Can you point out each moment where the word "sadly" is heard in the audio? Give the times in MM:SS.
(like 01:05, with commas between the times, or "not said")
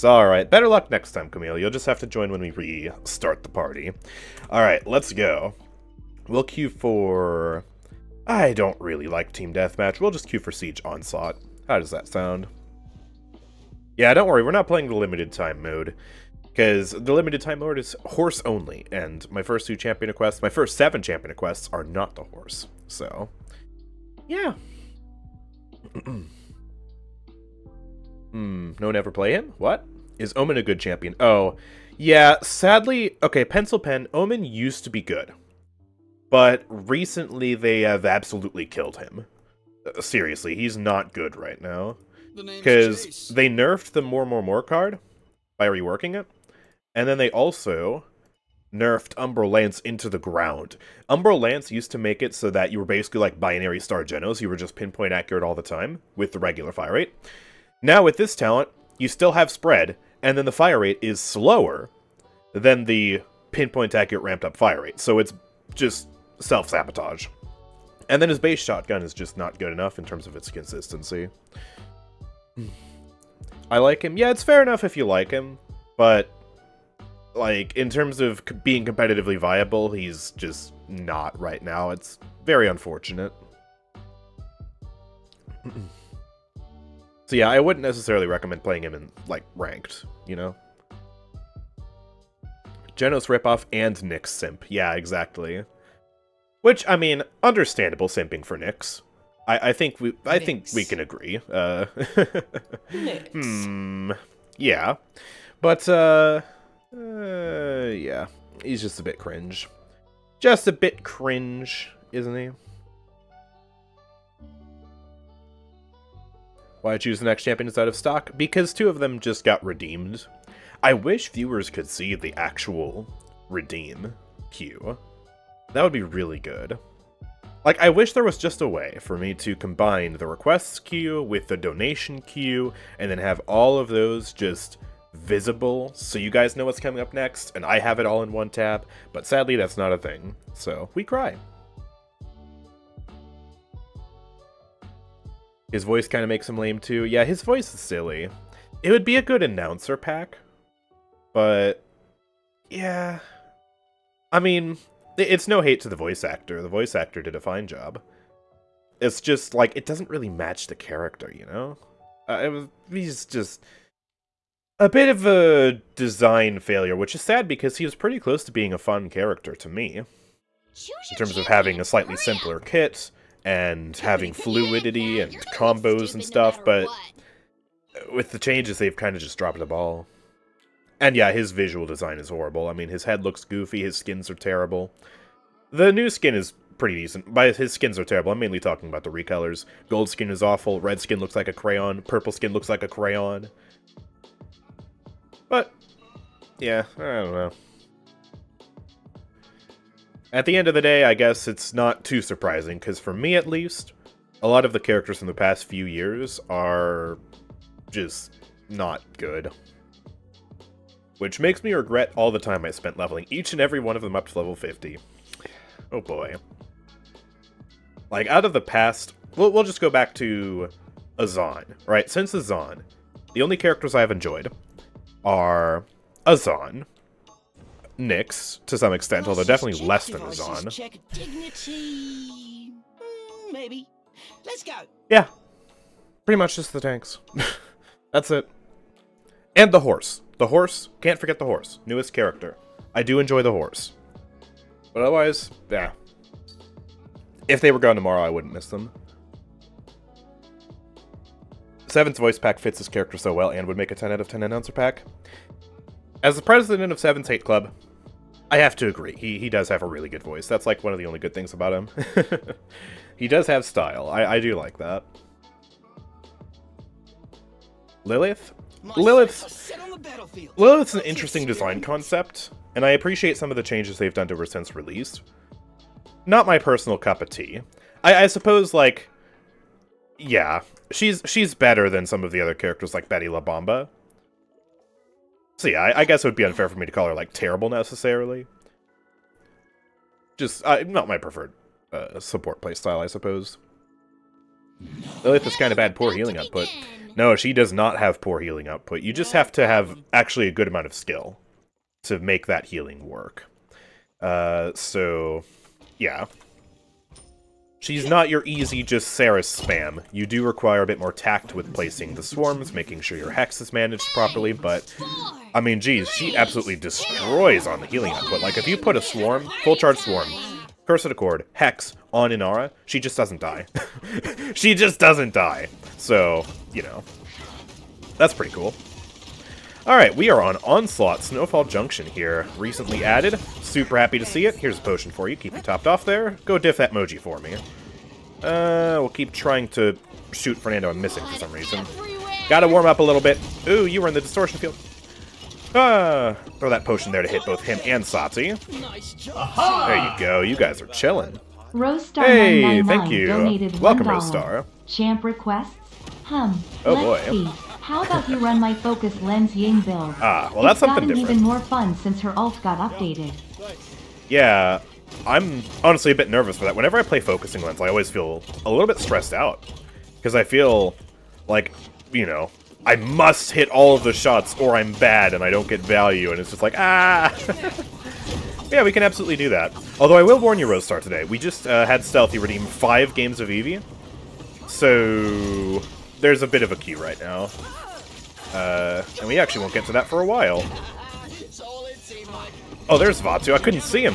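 00:32, 02:19.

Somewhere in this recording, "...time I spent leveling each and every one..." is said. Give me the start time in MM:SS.
03:32.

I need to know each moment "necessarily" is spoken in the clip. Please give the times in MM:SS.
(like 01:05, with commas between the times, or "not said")
01:27, 04:47.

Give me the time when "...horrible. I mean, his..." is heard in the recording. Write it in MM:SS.
03:02.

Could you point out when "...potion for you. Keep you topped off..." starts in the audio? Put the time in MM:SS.
05:34.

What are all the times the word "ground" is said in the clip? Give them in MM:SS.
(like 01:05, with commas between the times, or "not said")
00:50.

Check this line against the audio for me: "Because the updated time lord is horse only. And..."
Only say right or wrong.
wrong.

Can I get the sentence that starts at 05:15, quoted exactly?
I mean, geez, she absolutely destroys on the healing output.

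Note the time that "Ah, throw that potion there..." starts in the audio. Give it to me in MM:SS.
05:45.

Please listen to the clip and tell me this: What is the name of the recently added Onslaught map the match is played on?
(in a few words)
Snowfall Junction.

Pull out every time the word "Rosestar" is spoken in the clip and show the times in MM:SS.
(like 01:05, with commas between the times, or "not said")
05:54, 06:20.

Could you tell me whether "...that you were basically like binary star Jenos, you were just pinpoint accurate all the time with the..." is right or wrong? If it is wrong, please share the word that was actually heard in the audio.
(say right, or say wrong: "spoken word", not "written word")
right.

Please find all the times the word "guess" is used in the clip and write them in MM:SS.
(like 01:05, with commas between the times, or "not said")
03:21, 04:46.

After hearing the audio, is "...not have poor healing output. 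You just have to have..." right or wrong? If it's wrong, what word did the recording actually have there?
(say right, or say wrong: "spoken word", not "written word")
right.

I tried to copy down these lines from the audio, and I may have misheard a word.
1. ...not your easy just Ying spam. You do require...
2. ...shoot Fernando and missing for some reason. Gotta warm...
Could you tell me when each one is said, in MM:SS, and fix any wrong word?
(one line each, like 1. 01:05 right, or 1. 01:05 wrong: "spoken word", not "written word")
1. 05:08 wrong: "Seris", not "Ying"
2. 05:40 right.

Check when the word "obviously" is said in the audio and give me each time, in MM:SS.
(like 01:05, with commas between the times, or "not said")
not said.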